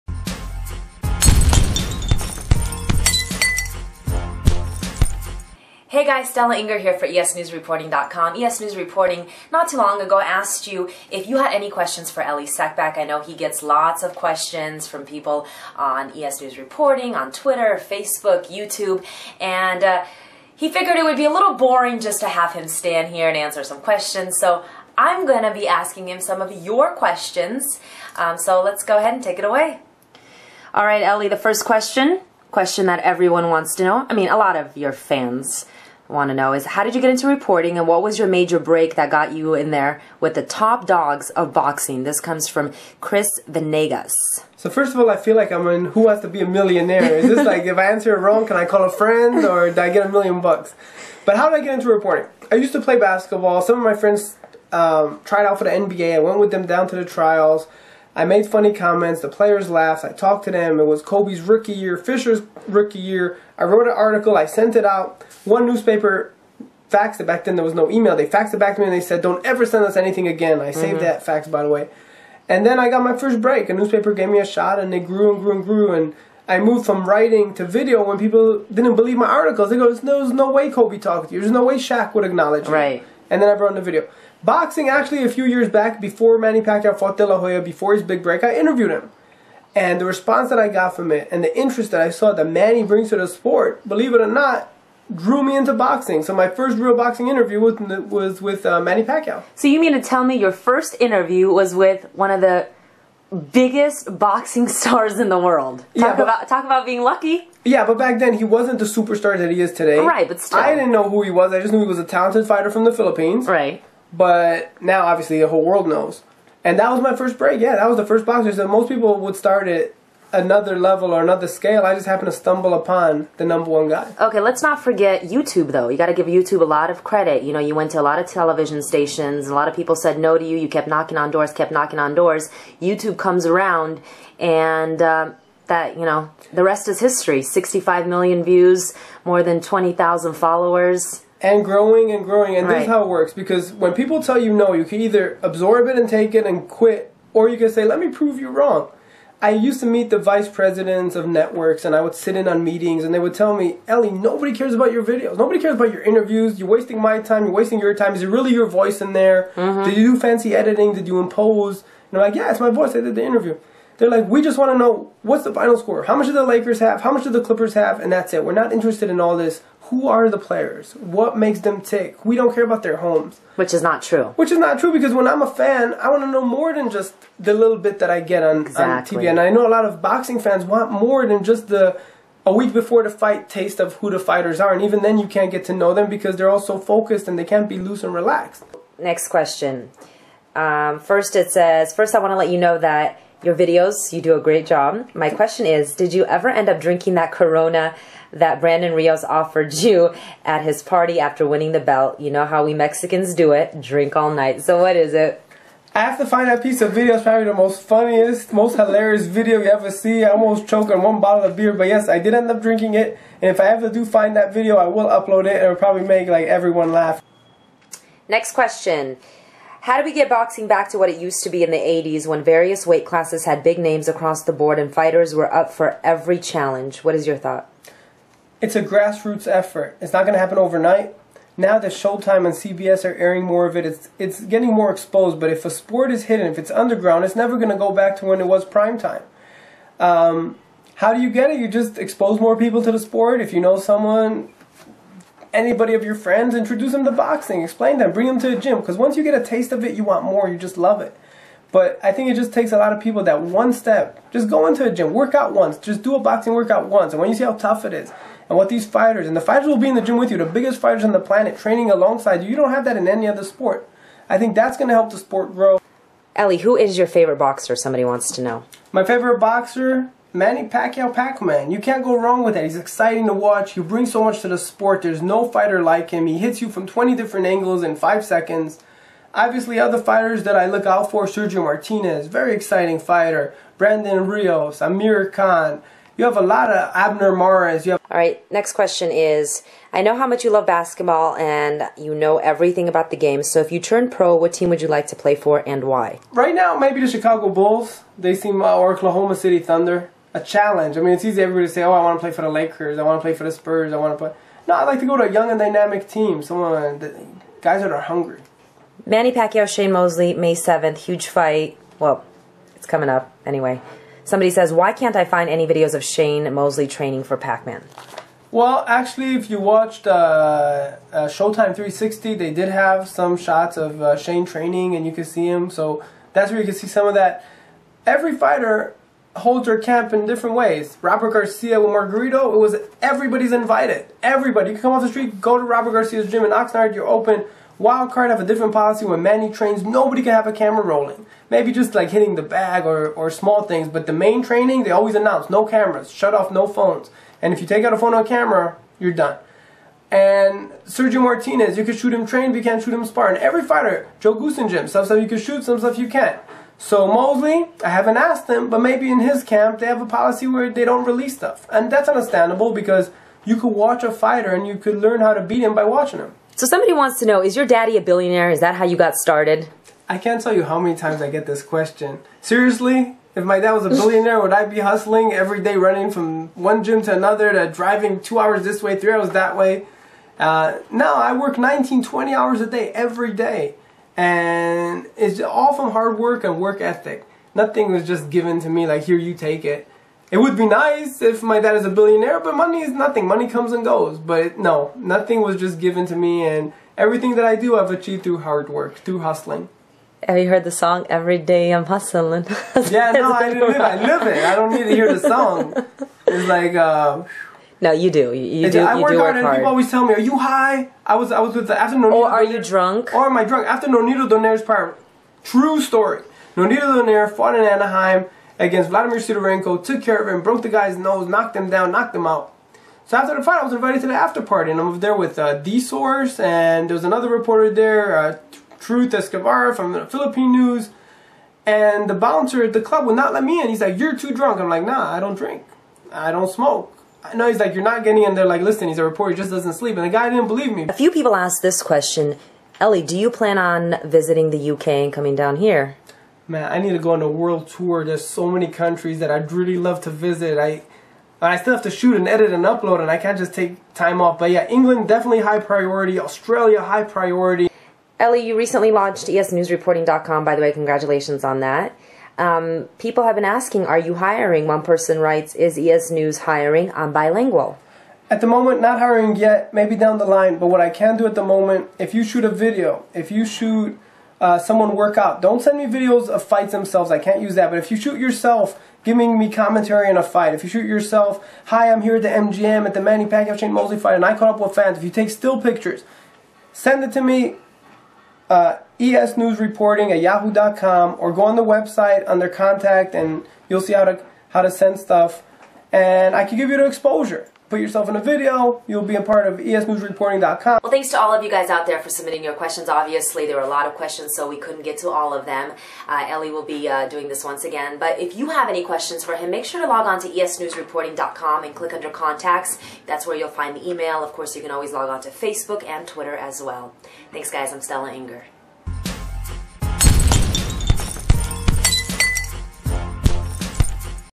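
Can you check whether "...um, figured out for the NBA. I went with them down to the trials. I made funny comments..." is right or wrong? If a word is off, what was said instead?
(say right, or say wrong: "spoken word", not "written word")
wrong: "tried", not "figured".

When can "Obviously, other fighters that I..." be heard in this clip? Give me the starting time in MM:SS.
04:39.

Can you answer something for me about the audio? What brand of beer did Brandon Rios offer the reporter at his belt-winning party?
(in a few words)
Corona.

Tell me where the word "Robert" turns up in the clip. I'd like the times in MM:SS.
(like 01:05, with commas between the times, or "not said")
05:31, 05:35.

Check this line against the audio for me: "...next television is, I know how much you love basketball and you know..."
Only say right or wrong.
wrong.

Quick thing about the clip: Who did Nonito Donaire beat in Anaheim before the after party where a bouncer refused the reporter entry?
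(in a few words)
Vladimir Sidorenko.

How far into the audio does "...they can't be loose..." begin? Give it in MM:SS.
03:07.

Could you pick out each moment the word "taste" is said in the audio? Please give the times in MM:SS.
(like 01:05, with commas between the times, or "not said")
03:03, 04:09.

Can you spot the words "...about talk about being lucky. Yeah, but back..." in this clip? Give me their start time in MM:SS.
01:46.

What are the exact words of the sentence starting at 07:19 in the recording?
And the guy didn't believe me.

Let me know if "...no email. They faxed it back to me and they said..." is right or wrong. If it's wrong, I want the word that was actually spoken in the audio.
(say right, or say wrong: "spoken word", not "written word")
right.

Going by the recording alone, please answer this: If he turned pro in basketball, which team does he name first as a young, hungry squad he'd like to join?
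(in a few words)
Chicago Bulls.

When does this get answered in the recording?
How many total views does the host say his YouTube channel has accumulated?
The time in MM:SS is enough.
02:17.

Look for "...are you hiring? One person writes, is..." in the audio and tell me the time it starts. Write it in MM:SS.
07:43.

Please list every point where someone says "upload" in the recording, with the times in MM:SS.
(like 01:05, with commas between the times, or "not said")
03:35, 07:32.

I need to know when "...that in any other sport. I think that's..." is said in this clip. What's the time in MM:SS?
04:22.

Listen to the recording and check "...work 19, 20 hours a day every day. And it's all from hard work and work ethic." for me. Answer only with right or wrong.
right.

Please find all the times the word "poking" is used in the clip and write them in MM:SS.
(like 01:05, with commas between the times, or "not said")
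not said.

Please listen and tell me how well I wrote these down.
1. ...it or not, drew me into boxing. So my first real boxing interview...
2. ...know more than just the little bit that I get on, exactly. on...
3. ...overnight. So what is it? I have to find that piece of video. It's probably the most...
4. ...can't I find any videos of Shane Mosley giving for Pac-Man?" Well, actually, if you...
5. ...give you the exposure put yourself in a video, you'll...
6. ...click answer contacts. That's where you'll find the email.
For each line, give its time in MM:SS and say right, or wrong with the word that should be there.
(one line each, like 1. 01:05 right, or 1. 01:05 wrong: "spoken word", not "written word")
1. 01:34 right
2. 02:56 right
3. 03:24 wrong: "night", not "overnight"
4. 05:14 wrong: "training", not "giving"
5. 08:16 right
6. 08:31 wrong: "under", not "answer".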